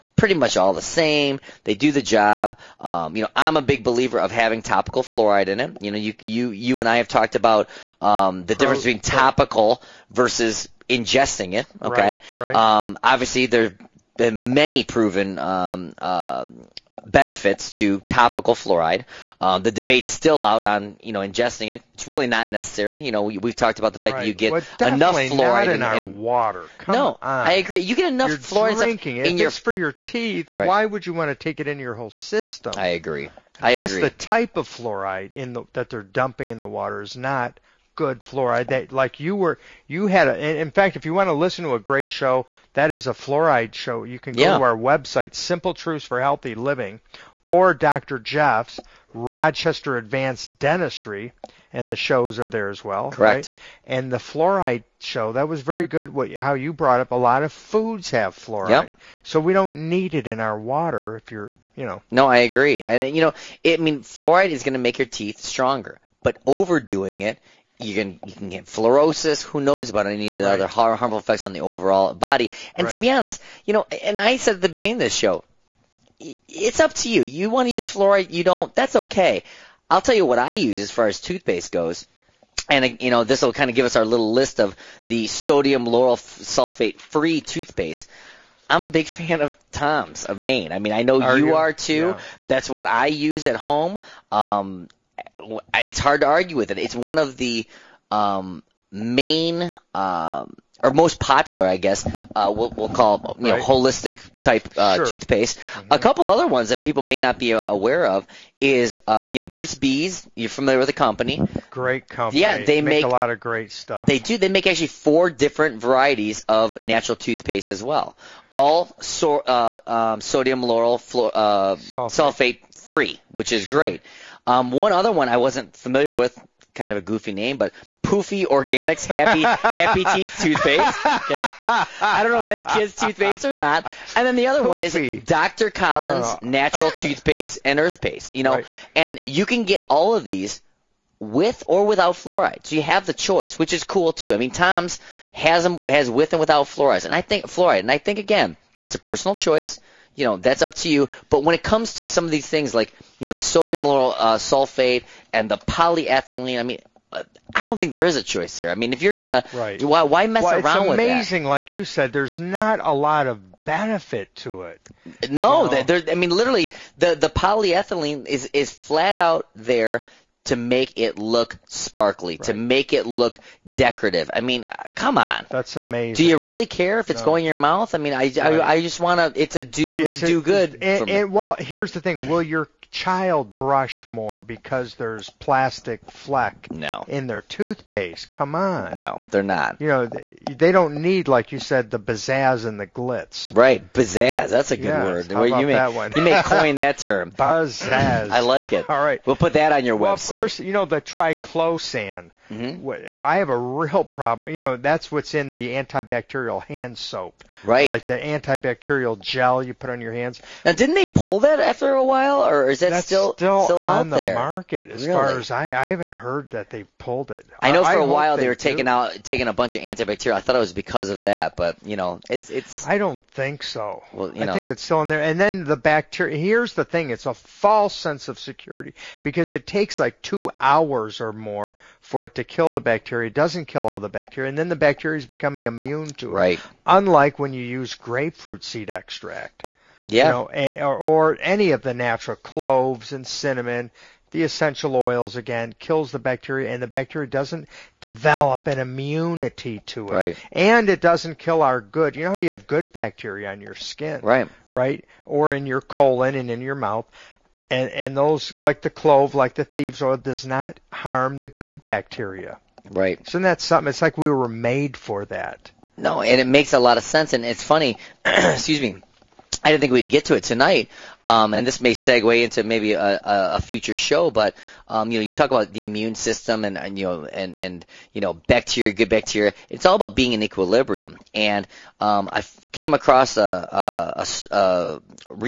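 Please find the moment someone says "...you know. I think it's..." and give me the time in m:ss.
3:44.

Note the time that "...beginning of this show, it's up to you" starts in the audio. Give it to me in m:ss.
1:14.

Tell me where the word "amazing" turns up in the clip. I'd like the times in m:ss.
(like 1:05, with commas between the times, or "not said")
2:41, 2:55.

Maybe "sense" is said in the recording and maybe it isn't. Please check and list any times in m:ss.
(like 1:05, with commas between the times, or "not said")
3:47, 4:27.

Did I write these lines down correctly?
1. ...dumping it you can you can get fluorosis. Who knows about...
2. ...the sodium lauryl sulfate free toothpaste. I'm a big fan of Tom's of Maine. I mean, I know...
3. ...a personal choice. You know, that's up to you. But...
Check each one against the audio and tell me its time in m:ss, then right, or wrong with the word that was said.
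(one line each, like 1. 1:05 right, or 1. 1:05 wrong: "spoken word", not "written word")
1. 1:06 wrong: "overdoing", not "dumping"
2. 1:25 right
3. 2:28 right.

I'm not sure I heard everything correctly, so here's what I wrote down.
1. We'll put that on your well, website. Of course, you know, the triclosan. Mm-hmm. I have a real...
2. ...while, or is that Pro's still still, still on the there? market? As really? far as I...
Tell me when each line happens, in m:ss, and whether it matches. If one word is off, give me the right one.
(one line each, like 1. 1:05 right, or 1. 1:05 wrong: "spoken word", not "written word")
1. 3:19 right
2. 3:32 wrong: "That", not "Pro".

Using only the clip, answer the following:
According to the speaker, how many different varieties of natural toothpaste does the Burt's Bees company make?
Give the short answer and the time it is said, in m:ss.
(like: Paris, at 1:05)
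4, at 1:54.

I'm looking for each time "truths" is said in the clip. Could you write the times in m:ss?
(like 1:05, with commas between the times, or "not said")
0:45.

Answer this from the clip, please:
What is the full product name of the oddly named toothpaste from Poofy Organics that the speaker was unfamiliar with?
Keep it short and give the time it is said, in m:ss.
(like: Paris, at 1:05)
Happy Happy Teeth, at 2:09.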